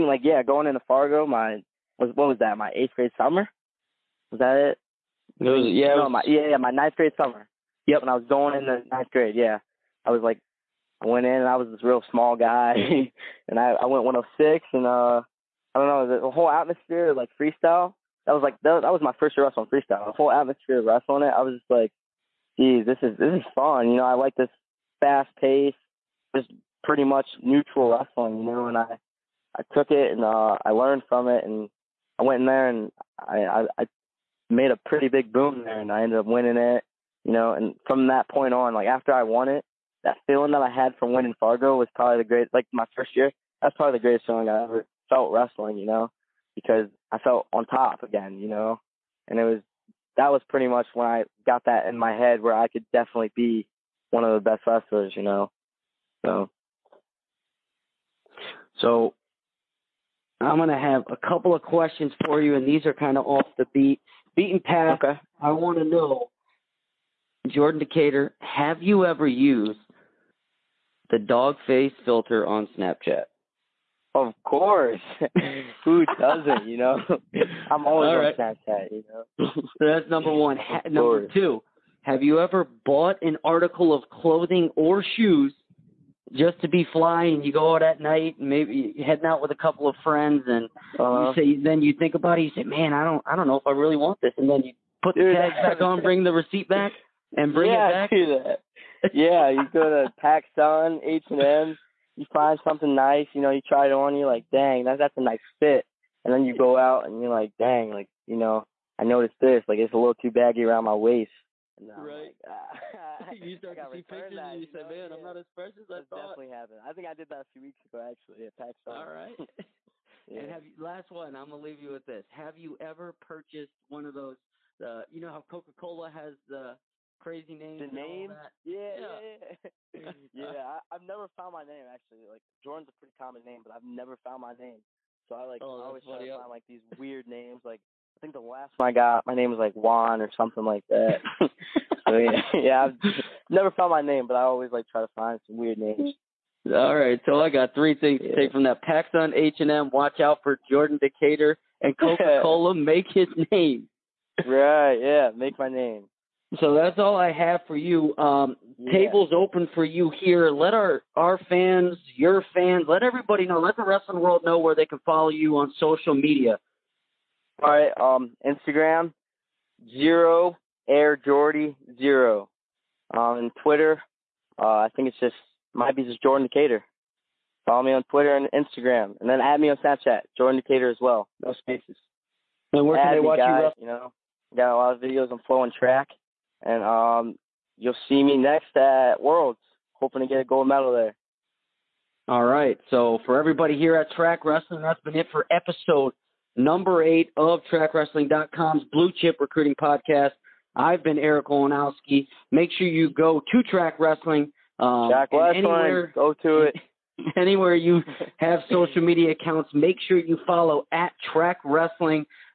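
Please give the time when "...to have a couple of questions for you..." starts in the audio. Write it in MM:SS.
01:00.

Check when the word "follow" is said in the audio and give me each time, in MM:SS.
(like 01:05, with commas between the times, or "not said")
02:45, 02:57, 03:30.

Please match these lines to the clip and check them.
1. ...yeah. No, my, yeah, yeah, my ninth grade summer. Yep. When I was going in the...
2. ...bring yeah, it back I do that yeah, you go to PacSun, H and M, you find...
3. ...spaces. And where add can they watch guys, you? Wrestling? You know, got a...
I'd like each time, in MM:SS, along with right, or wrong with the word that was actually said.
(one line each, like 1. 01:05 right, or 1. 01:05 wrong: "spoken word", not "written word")
1. 00:05 right
2. 01:37 right
3. 03:01 right.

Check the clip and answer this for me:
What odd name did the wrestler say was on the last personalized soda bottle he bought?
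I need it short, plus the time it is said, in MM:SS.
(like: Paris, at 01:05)
Juan, at 02:19.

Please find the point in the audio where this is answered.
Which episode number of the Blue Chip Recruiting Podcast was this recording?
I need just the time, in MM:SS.
03:15.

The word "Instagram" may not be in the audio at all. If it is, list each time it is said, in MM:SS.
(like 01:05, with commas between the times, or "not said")
02:48, 02:58.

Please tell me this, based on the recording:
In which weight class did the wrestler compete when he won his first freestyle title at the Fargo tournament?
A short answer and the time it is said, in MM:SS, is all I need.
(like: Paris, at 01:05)
106, at 00:14.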